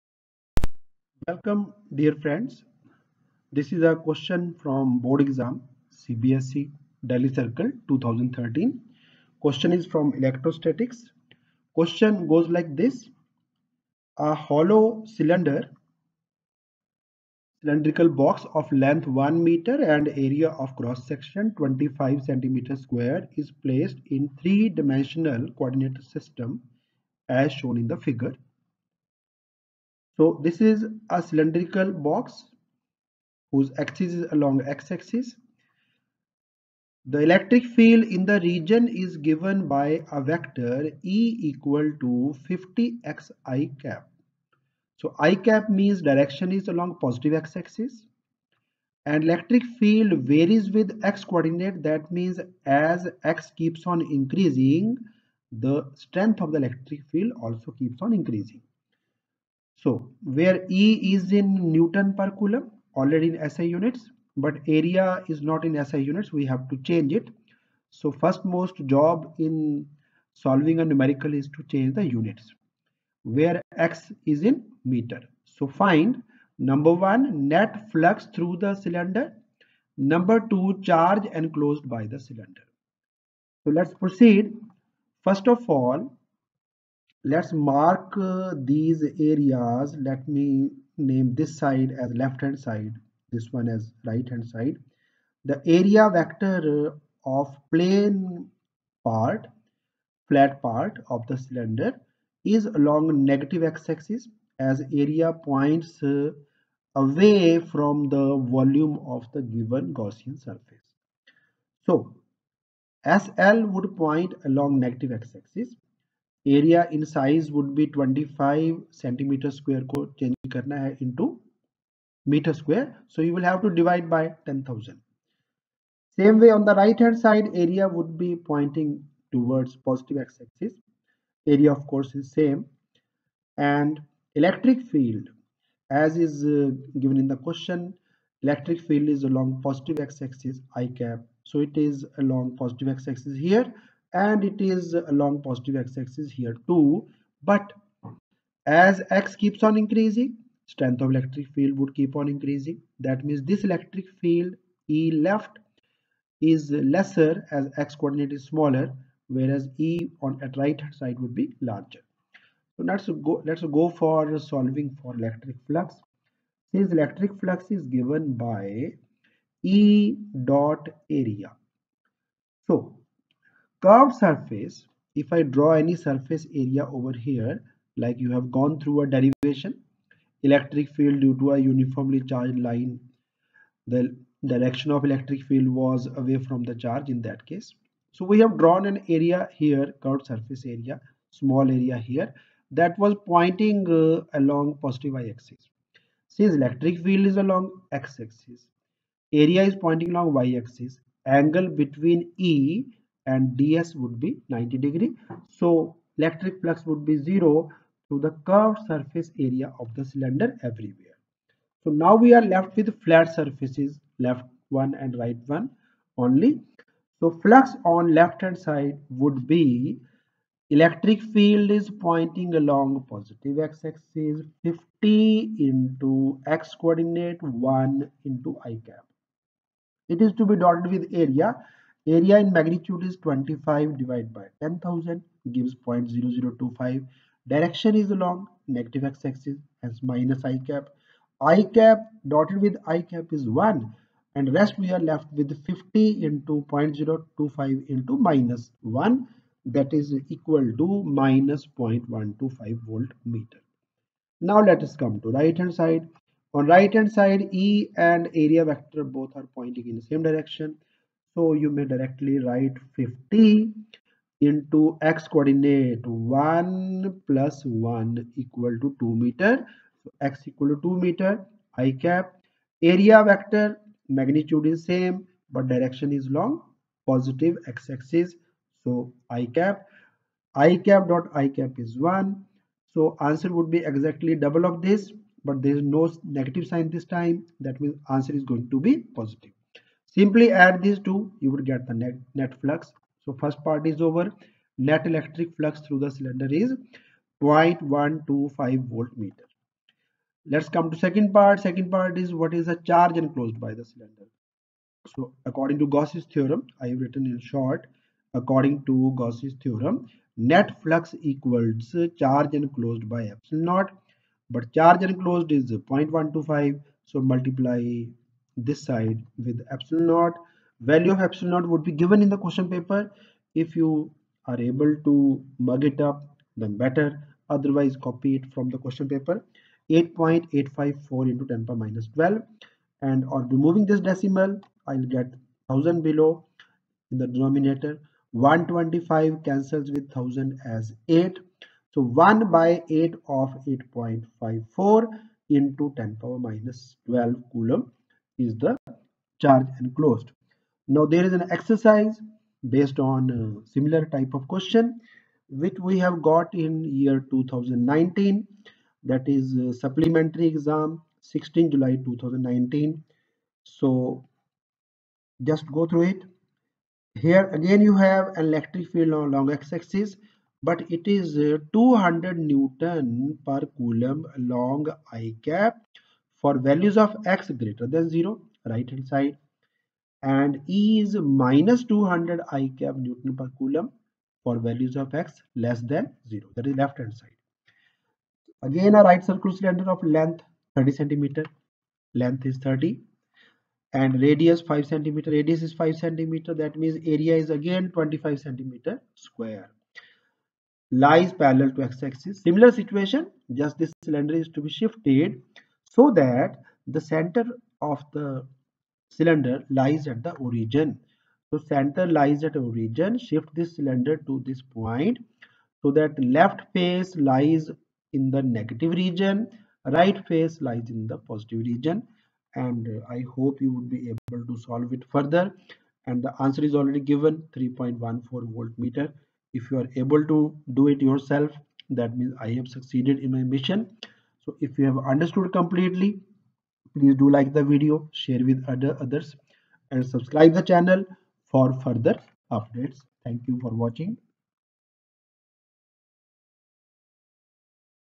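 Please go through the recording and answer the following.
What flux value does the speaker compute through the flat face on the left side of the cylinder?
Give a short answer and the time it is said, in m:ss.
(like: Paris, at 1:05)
-0.125 volt meter, at 4:11.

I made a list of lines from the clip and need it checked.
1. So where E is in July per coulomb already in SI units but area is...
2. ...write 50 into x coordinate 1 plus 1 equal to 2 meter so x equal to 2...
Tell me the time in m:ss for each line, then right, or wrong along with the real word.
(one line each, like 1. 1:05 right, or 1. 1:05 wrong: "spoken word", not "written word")
1. 0:59 wrong: "Newton", not "July"
2. 4:22 right.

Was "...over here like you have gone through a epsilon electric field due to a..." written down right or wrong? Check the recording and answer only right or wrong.
wrong.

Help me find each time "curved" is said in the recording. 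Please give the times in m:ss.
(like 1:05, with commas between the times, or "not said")
2:53, 3:10, 3:28.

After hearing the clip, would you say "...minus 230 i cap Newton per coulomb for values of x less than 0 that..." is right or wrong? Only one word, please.
wrong.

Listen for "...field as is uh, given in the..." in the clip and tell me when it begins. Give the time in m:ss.
2:14.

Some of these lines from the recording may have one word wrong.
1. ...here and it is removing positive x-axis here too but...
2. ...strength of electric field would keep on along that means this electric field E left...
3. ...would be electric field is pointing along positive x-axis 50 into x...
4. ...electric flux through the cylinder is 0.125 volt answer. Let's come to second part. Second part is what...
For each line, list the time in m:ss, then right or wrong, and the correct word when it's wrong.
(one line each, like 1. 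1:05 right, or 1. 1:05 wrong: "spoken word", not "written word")
1. 2:23 wrong: "along", not "removing"
2. 2:30 wrong: "increasing", not "along"
3. 3:39 right
4. 4:55 wrong: "meter", not "answer".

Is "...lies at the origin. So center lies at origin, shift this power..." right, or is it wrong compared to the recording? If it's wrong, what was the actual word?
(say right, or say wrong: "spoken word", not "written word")
wrong: "cylinder", not "power".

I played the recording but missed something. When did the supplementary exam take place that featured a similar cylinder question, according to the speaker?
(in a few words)
16 July 2019.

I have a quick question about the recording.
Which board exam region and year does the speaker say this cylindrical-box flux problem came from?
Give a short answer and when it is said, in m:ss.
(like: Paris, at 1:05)
CBSE Delhi Circle 2013, at 0:05.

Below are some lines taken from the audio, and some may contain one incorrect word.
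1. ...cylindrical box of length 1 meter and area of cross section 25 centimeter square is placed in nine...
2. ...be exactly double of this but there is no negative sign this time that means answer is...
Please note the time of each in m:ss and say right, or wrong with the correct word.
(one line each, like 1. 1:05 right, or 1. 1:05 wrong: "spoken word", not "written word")
1. 0:17 wrong: "three", not "nine"
2. 4:43 right.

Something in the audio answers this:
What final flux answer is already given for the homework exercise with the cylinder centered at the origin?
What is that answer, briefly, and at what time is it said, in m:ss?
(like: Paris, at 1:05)
3.14 volt meter, at 7:07.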